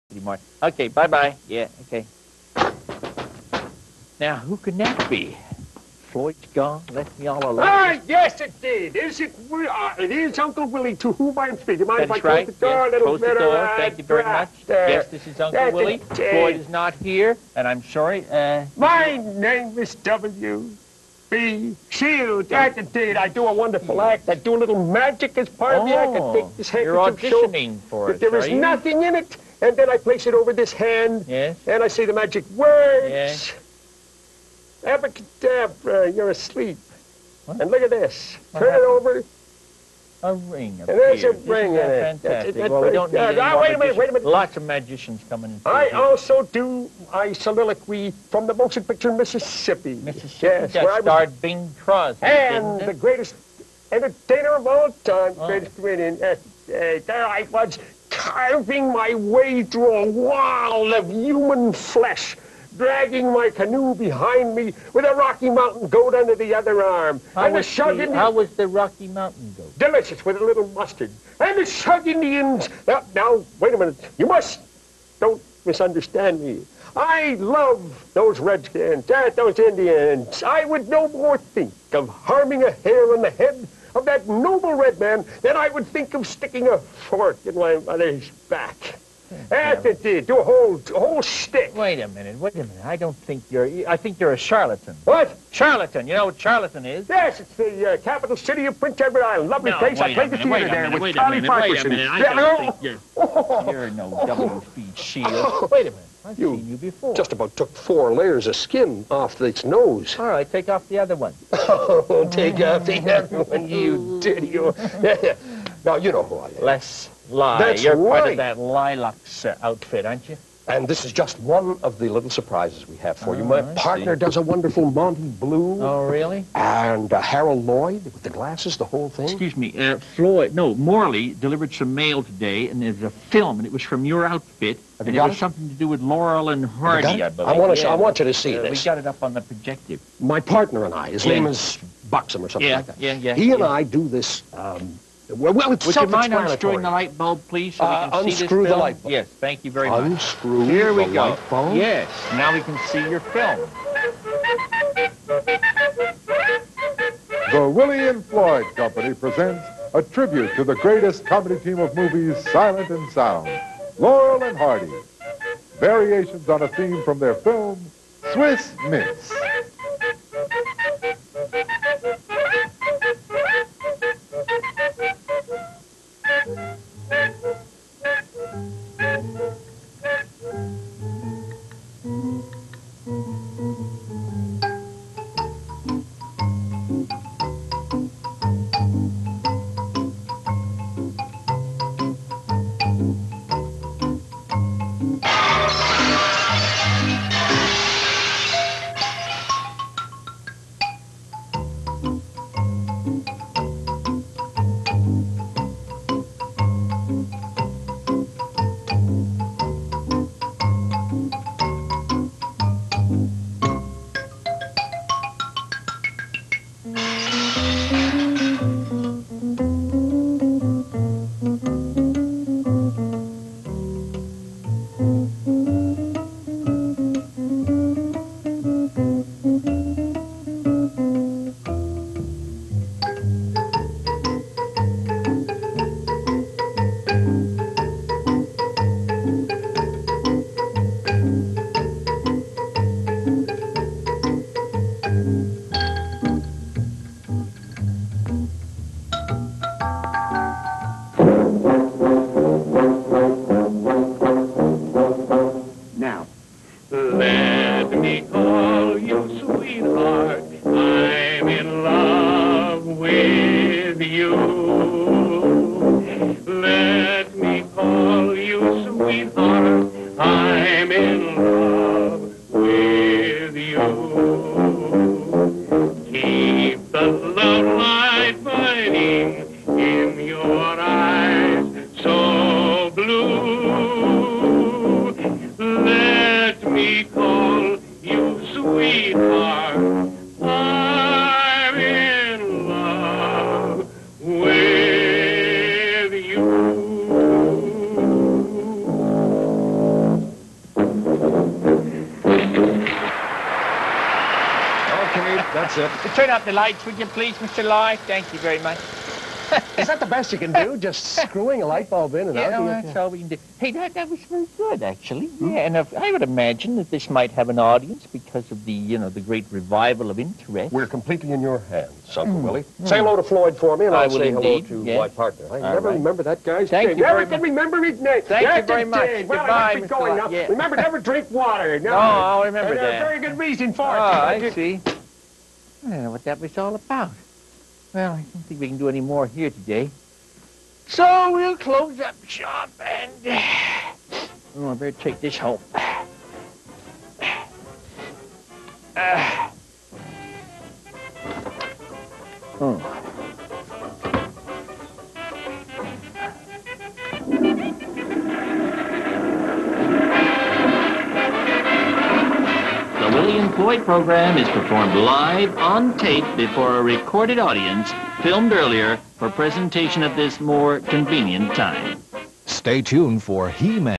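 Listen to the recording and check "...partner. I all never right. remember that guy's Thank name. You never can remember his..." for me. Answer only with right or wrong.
right.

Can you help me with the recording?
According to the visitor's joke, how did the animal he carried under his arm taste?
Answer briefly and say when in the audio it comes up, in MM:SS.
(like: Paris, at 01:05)
Delicious with a little mustard, at 01:09.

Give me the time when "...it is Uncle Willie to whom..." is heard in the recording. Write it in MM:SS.
00:09.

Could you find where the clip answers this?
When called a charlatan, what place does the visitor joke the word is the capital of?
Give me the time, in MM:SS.
01:38.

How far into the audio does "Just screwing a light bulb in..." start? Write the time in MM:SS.
05:10.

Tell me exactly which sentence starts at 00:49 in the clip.
Mississippi yes, where I starred Bing Crosby.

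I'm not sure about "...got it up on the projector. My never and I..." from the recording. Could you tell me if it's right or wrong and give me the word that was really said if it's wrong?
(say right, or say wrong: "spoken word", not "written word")
wrong: "partner", not "never".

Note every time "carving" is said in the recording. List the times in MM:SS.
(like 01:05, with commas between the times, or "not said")
00:58.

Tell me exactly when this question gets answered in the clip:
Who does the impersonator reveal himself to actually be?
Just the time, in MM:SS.
01:56.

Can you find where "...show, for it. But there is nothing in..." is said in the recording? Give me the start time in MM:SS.
00:27.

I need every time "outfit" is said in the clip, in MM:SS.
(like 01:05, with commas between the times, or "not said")
01:59, 02:14.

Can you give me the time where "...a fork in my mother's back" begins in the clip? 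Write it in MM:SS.
01:26.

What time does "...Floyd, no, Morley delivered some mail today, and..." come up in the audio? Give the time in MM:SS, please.
02:10.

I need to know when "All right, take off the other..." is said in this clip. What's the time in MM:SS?
01:50.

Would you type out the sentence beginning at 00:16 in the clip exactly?
Floyd is not here, and I'm sorry.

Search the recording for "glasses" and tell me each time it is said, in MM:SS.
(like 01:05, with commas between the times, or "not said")
02:08.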